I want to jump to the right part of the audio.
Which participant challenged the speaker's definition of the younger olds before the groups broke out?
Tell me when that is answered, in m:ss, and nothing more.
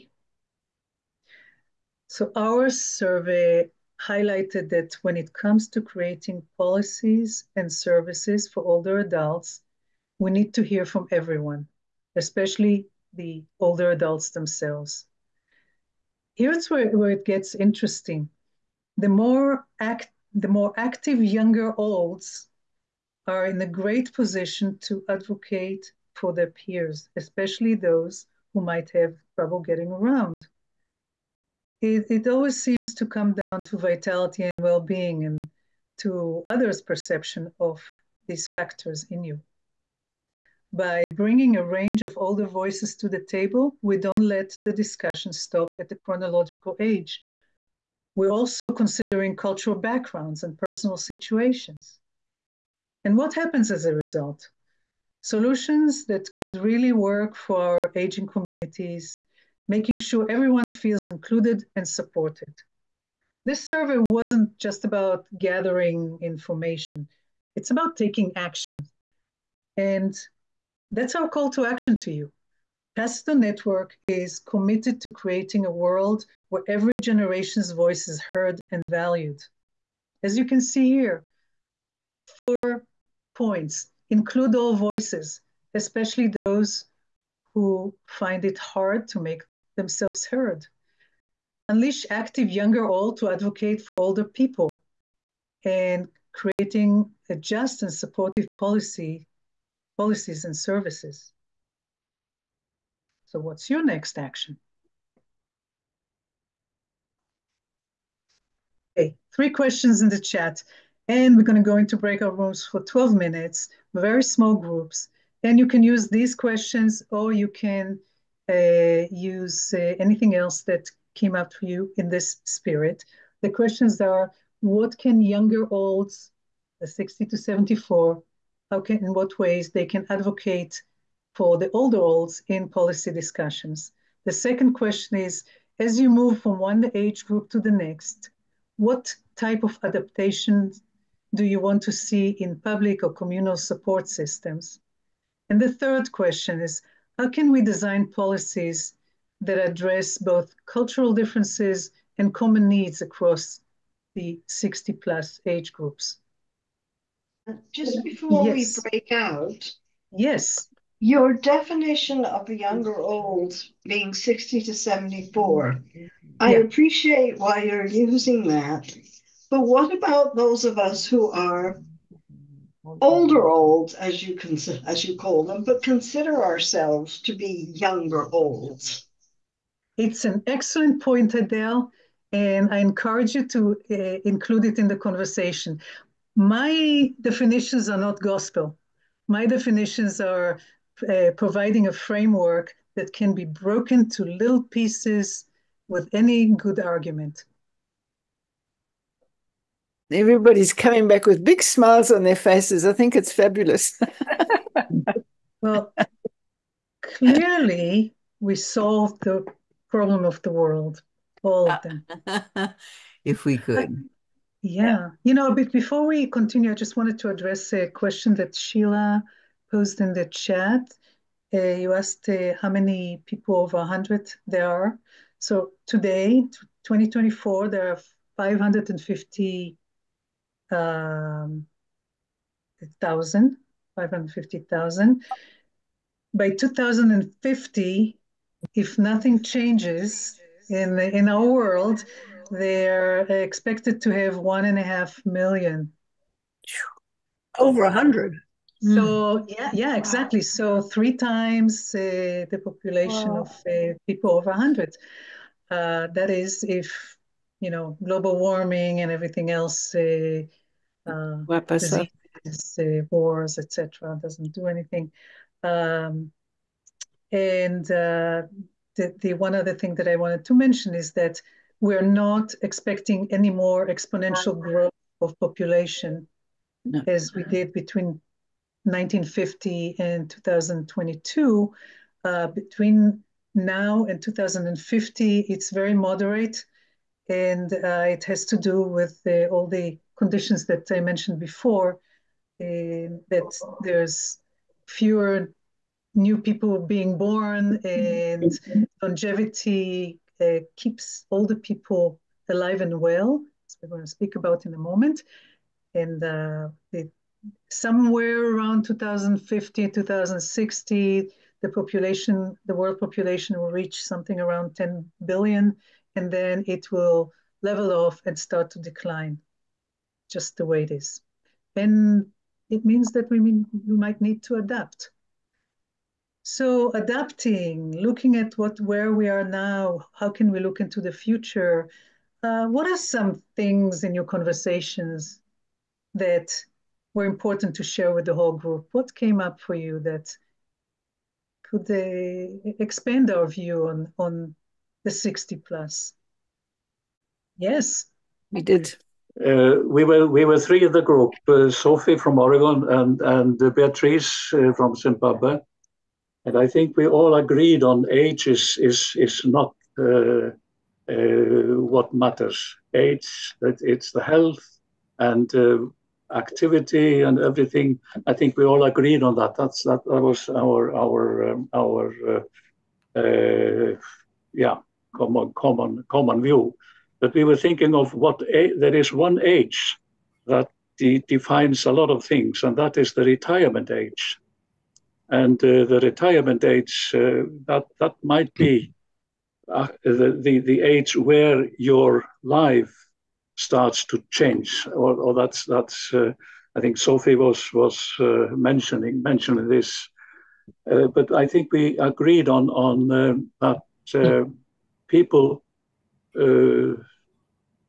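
3:01.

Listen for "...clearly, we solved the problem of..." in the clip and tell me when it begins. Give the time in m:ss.
3:27.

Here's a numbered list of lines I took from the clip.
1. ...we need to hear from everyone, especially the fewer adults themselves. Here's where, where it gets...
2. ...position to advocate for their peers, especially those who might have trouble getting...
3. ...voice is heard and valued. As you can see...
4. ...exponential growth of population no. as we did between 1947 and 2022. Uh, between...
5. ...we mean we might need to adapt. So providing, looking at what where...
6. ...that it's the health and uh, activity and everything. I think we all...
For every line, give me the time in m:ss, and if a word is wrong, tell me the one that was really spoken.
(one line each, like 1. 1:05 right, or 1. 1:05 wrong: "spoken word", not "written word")
1. 0:10 wrong: "older", not "fewer"
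2. 0:24 right
3. 1:17 right
4. 4:33 wrong: "1950", not "1947"
5. 5:23 wrong: "adapting", not "providing"
6. 6:03 right.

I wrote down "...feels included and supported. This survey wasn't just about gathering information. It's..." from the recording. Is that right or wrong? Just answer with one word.
right.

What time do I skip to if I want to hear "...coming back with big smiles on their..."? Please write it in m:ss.
3:20.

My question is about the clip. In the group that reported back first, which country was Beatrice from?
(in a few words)
Zimbabwe.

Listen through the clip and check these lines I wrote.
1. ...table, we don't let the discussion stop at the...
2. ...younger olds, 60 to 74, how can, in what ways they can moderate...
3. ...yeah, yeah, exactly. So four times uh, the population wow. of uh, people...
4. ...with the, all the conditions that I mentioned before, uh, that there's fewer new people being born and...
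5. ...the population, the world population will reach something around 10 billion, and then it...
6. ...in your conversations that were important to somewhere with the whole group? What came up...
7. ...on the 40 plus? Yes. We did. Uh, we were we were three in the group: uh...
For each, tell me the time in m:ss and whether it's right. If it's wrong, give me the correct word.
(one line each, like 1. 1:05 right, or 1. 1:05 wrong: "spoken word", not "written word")
1. 0:43 right
2. 2:05 wrong: "advocate", not "moderate"
3. 4:09 wrong: "three", not "four"
4. 4:48 right
5. 5:11 right
6. 5:34 wrong: "share", not "somewhere"
7. 5:44 wrong: "60", not "40".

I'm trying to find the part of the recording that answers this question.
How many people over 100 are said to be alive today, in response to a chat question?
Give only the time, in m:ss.
3:53.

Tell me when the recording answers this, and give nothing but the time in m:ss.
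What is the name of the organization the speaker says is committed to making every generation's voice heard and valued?
1:12.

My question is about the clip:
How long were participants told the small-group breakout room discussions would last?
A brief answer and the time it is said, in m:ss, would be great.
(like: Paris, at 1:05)
12 minutes, at 1:52.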